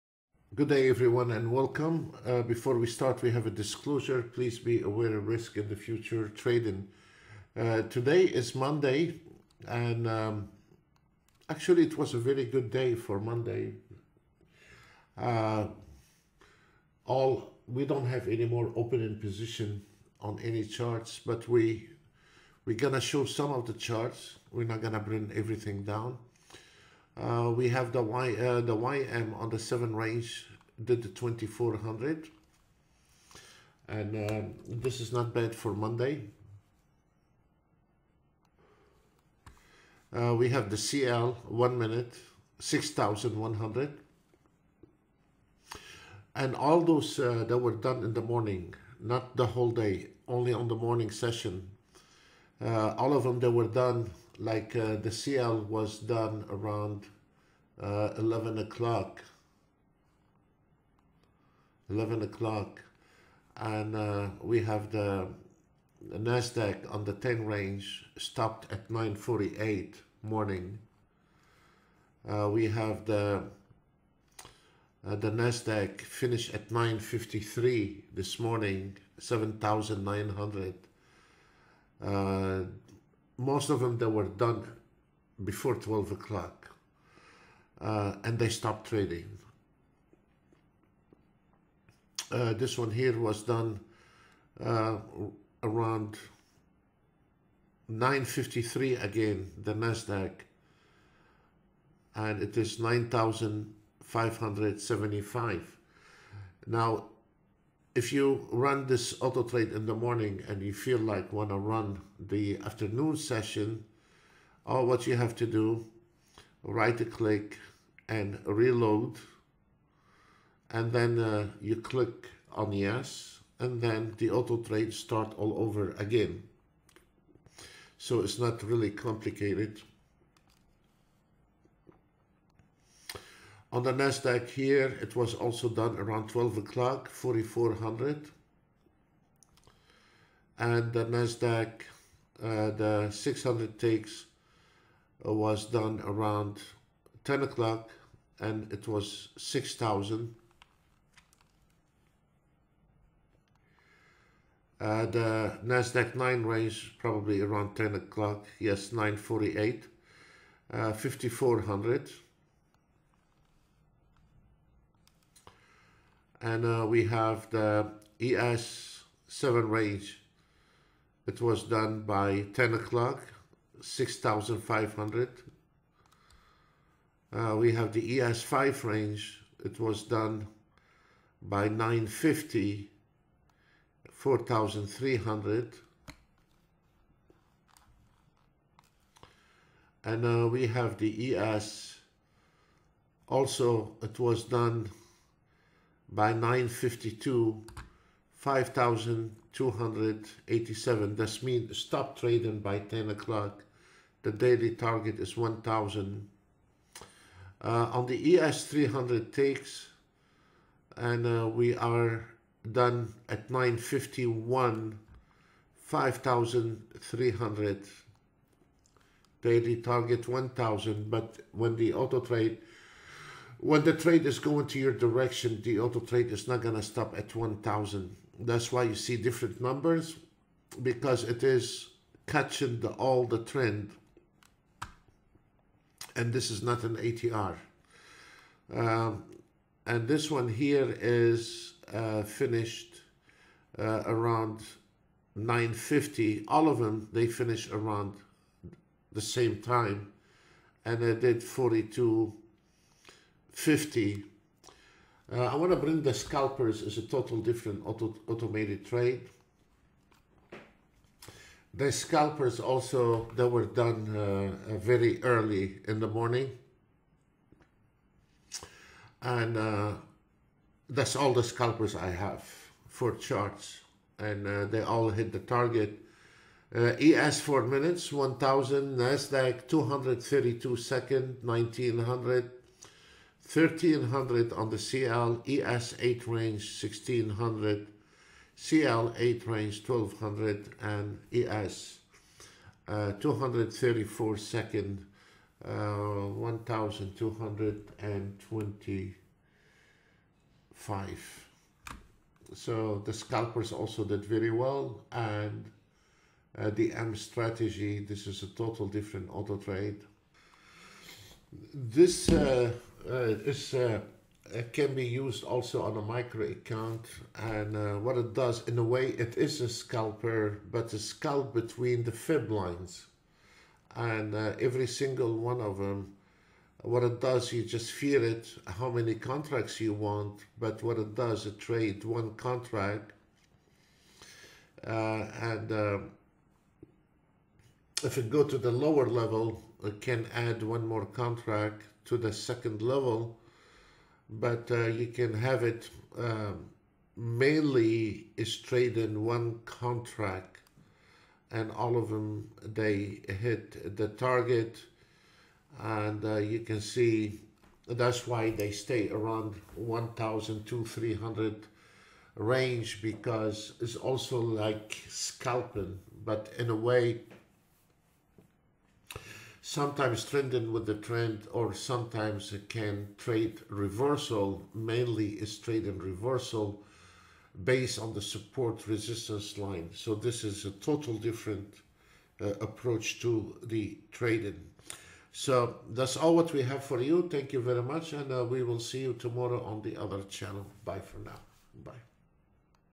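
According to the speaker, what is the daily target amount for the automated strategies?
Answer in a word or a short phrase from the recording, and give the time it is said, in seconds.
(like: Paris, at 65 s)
1,000, at 204 s.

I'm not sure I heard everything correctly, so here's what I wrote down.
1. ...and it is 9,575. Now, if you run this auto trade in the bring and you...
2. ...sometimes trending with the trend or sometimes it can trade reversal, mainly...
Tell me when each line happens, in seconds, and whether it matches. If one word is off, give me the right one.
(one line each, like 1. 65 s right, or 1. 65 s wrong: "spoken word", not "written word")
1. 102 s wrong: "morning", not "bring"
2. 369 s right.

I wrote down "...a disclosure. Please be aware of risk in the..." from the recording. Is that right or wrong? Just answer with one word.
right.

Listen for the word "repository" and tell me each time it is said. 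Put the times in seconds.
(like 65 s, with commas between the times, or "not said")
not said.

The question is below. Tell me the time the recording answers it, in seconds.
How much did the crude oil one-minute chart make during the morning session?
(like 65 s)
42 s.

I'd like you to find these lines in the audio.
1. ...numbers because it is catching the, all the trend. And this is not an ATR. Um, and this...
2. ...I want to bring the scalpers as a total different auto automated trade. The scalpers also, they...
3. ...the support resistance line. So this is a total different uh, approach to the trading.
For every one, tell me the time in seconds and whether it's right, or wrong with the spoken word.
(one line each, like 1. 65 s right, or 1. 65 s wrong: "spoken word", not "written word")
1. 229 s right
2. 255 s right
3. 378 s right.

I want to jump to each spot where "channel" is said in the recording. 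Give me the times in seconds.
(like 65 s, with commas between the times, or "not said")
390 s.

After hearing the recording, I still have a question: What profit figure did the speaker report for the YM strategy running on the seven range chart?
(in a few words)
2400.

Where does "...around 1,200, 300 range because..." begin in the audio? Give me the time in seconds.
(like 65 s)
359 s.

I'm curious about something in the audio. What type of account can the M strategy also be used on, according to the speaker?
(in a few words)
A micro account.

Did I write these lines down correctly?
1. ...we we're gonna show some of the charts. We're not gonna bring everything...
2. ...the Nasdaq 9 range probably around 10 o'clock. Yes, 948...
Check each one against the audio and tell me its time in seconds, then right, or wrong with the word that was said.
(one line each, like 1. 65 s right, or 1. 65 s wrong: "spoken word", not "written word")
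1. 21 s right
2. 155 s right.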